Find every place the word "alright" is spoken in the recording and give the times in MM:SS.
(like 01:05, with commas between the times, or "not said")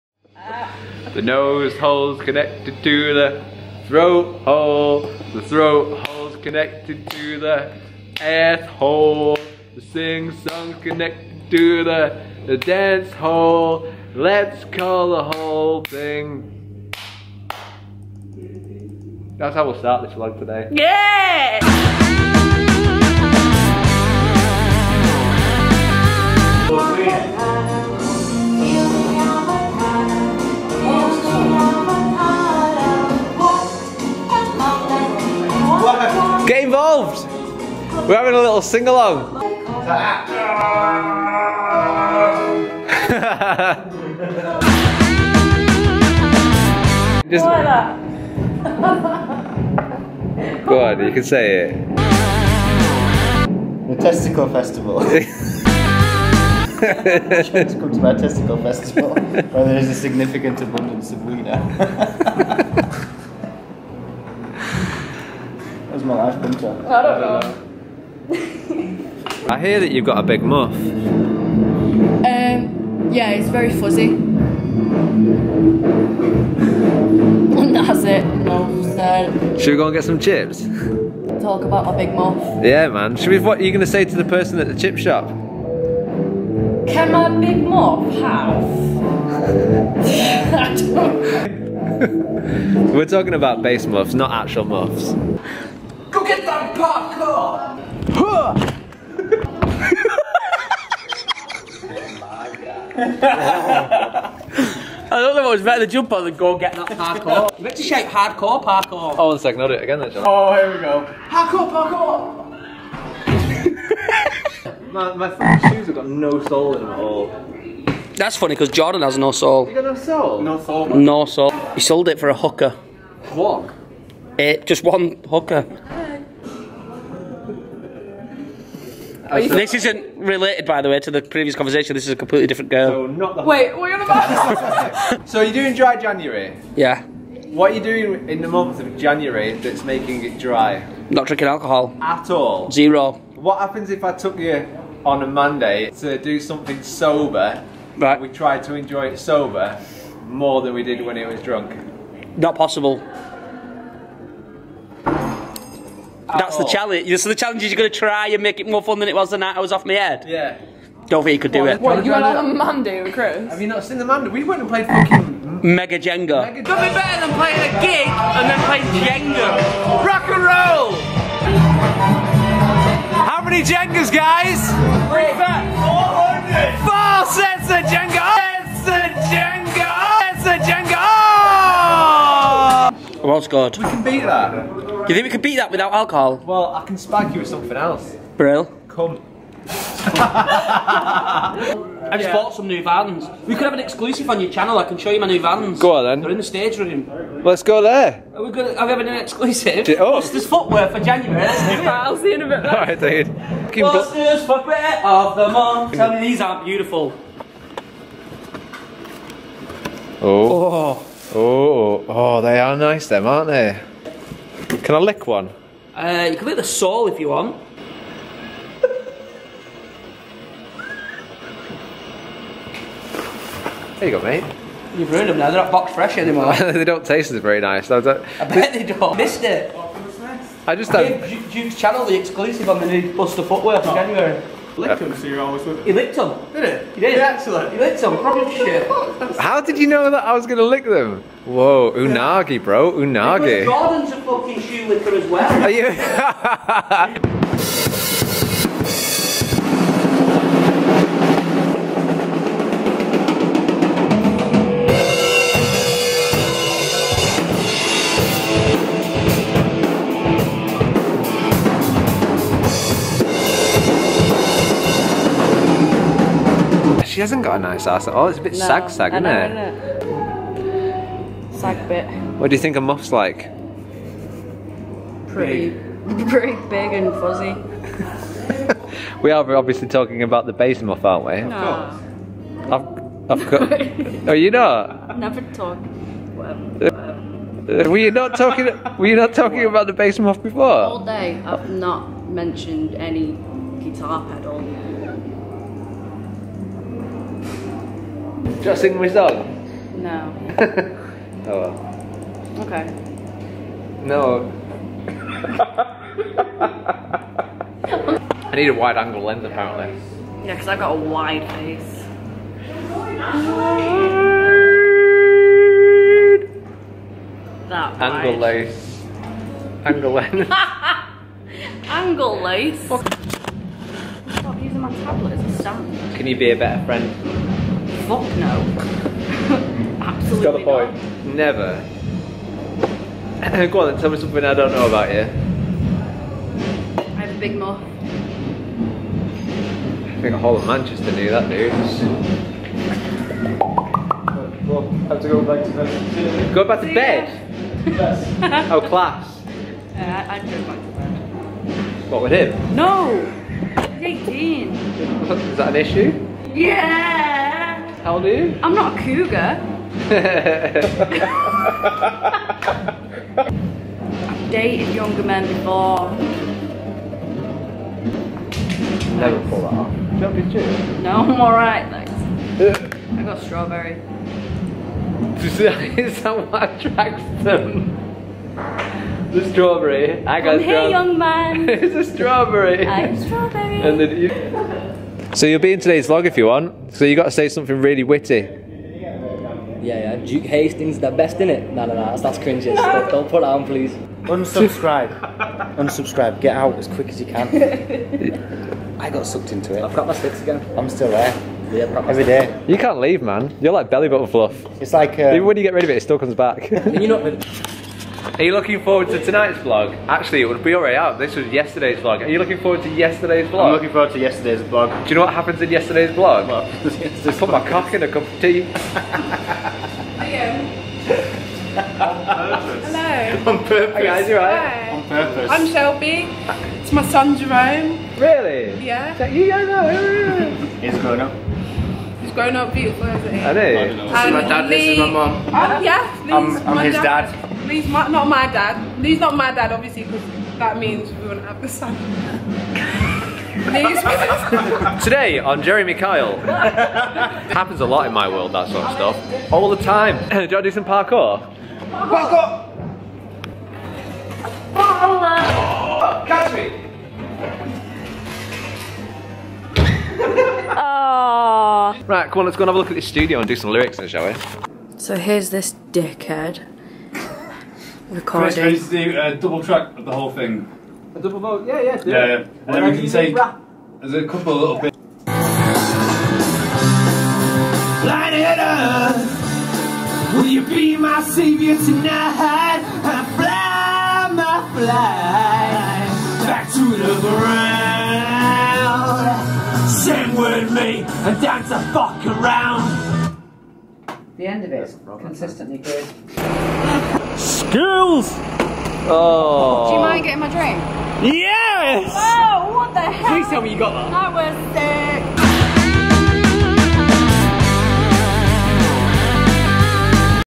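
03:22, 06:11.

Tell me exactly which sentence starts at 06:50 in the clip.
Actually, it would be already out.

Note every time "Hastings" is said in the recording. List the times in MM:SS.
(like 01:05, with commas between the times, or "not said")
06:30.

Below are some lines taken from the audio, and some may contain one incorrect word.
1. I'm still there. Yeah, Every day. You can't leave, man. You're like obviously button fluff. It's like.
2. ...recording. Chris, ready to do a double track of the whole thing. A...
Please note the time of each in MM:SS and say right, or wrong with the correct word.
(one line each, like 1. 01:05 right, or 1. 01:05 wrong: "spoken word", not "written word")
1. 06:40 wrong: "belly", not "obviously"
2. 07:48 right.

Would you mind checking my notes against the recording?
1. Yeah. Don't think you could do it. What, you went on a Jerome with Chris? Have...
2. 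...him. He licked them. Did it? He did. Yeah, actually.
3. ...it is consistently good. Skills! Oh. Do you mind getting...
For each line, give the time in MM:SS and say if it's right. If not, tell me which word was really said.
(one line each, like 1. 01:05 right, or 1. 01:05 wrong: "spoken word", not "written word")
1. 02:40 wrong: "Monday", not "Jerome"
2. 03:55 right
3. 08:14 right.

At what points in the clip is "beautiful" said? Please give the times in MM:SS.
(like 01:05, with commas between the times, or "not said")
03:26, 07:12.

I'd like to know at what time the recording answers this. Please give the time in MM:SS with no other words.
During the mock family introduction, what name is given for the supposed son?
07:07.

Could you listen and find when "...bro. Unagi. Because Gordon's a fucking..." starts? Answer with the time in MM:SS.
04:02.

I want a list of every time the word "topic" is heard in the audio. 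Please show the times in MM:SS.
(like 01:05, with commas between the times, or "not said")
not said.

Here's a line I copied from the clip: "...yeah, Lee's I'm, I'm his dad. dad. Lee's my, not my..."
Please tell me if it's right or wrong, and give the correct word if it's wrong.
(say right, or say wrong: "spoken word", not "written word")
right.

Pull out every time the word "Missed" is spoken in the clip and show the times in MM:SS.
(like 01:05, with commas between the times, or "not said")
03:49.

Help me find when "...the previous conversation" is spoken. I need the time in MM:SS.
02:11.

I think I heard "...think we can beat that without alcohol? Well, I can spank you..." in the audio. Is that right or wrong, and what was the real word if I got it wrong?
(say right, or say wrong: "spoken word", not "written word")
right.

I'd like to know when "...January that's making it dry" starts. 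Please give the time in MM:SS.
02:18.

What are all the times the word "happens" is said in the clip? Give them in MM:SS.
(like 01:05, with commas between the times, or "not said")
02:23, 06:55, 07:26.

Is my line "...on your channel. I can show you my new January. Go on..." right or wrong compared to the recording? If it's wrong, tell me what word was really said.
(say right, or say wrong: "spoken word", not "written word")
wrong: "Vans", not "January".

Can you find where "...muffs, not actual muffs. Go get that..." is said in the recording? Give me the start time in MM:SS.
01:33.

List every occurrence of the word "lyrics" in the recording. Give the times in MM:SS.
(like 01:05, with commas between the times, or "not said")
07:43.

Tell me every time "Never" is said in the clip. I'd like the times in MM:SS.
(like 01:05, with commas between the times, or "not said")
04:45, 05:31, 06:09.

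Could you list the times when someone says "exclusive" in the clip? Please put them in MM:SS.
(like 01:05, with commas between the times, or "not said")
03:13, 03:19, 03:52.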